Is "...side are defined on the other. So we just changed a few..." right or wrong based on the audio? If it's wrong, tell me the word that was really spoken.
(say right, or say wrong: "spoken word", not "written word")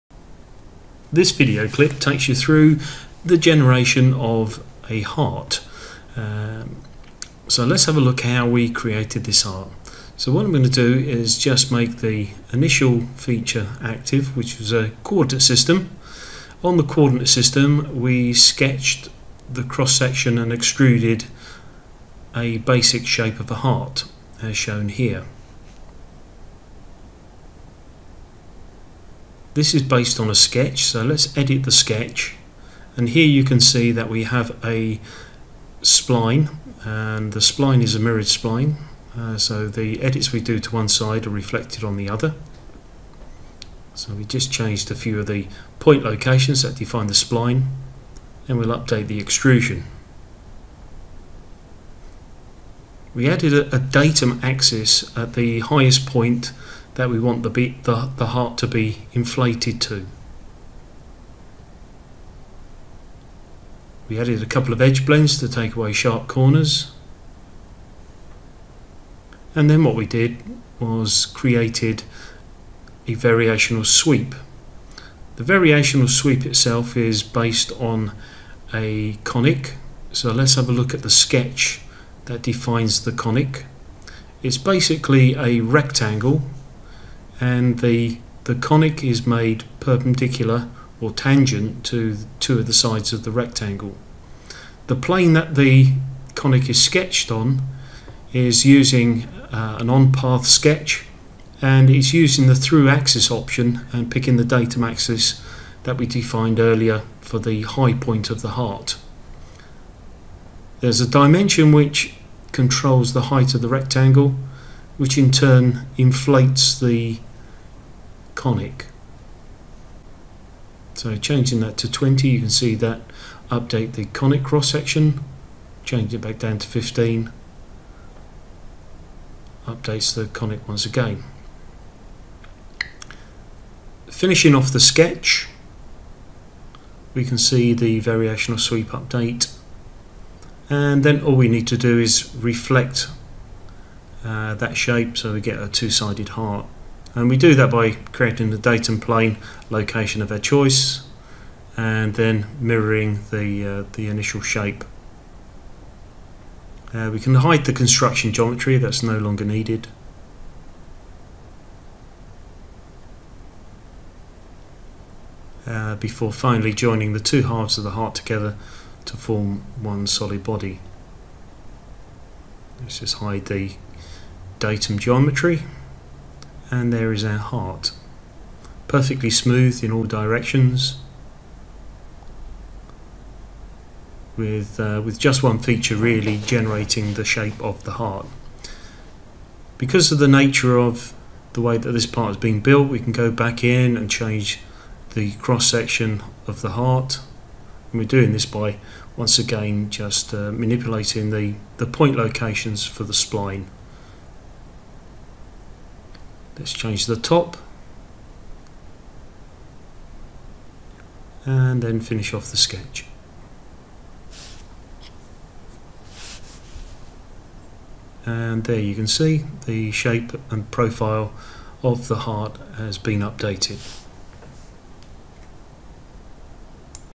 wrong: "reflected", not "defined".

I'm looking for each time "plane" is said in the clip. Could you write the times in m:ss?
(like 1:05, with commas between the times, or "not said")
1:34, 2:28.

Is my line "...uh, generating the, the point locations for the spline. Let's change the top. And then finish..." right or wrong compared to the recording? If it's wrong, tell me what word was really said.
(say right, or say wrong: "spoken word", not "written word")
wrong: "manipulating", not "generating".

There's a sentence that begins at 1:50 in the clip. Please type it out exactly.
There's a dimension which controls the height of the rectangle which in turn inflates the conic.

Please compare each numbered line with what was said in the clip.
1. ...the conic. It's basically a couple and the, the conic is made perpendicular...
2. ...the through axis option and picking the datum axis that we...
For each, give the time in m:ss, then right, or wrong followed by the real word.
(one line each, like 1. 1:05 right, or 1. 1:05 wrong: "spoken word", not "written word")
1. 1:23 wrong: "rectangle", not "couple"
2. 1:42 right.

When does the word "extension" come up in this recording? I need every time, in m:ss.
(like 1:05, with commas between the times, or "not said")
not said.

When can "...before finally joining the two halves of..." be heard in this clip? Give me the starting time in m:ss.
2:45.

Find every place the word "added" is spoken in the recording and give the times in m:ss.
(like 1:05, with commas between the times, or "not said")
0:53, 1:04.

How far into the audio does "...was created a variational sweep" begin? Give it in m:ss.
1:10.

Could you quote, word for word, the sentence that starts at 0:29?
This is based on a sketch, so let's edit the sketch.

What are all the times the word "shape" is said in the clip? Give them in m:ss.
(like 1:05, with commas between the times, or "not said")
0:23, 2:24, 2:34, 3:07, 3:39.